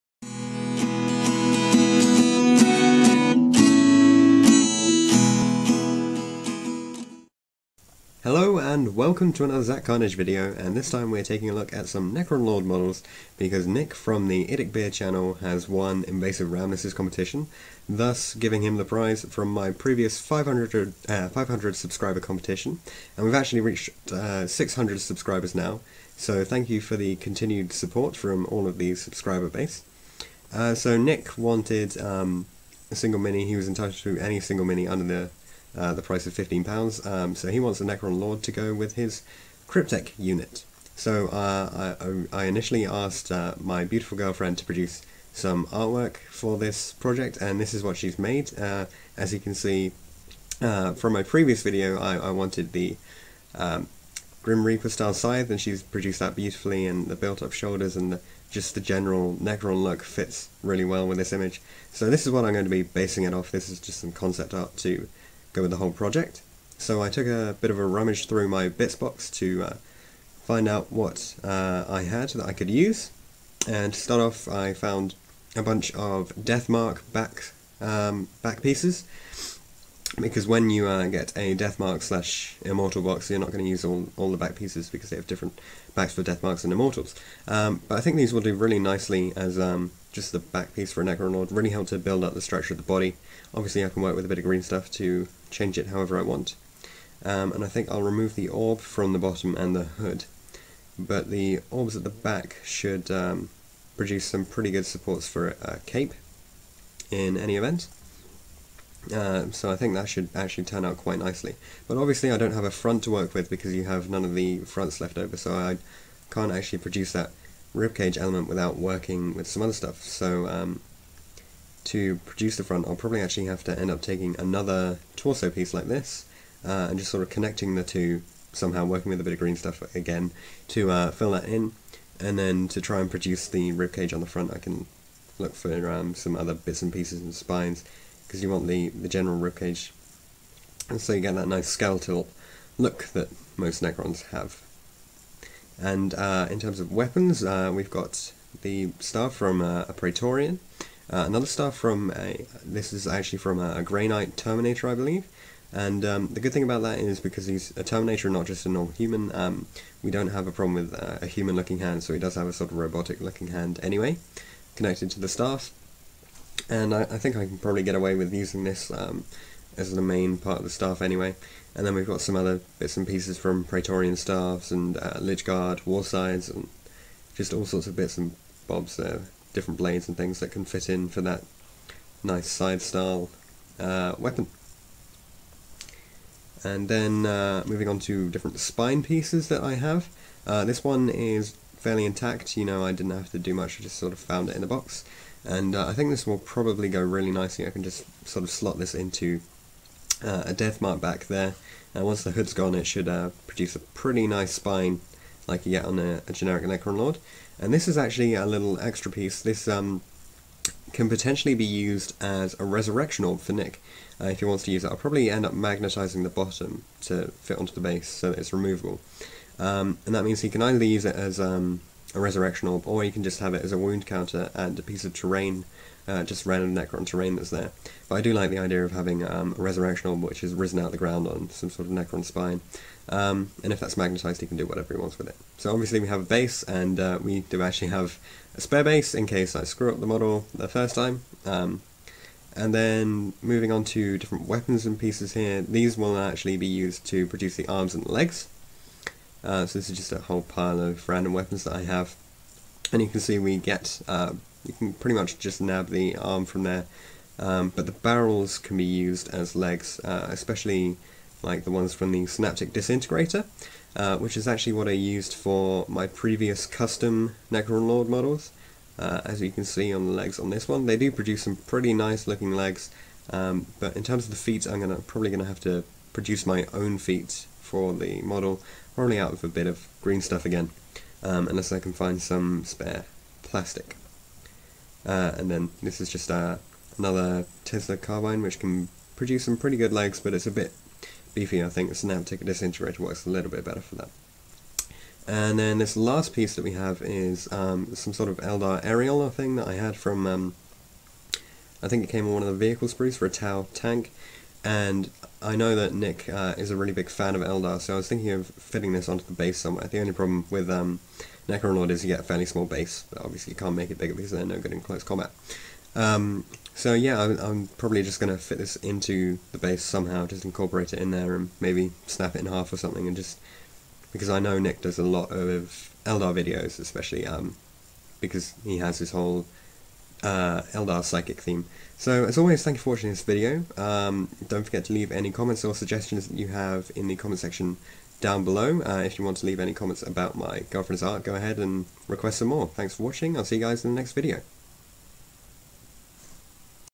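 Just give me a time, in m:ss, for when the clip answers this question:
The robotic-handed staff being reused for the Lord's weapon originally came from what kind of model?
2:33.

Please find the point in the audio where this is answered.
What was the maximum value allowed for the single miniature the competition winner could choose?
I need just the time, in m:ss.
0:36.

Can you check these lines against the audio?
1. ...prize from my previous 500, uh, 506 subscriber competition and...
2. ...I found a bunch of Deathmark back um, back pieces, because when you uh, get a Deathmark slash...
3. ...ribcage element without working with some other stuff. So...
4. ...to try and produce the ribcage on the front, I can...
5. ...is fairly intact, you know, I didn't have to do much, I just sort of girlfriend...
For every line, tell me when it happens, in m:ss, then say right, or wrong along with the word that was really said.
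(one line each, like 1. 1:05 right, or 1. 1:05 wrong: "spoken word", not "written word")
1. 0:18 wrong: "500", not "506"
2. 1:14 right
3. 1:57 right
4. 2:12 right
5. 3:11 wrong: "found", not "girlfriend".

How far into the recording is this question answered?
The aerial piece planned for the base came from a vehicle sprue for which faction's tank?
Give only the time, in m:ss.
5:03.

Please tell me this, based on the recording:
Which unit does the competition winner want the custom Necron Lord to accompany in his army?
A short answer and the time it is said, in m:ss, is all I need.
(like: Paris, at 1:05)
Cryptek unit, at 0:39.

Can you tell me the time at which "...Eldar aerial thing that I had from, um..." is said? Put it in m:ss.
4:58.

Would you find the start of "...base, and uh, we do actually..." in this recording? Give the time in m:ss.
3:56.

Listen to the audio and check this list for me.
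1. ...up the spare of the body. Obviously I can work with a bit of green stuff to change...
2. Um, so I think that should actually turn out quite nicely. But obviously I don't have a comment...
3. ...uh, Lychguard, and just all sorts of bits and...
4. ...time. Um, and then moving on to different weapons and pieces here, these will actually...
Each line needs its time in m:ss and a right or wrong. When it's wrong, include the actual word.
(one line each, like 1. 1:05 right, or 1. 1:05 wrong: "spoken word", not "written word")
1. 1:32 wrong: "structure", not "spare"
2. 1:49 wrong: "front", not "comment"
3. 2:54 right
4. 4:00 right.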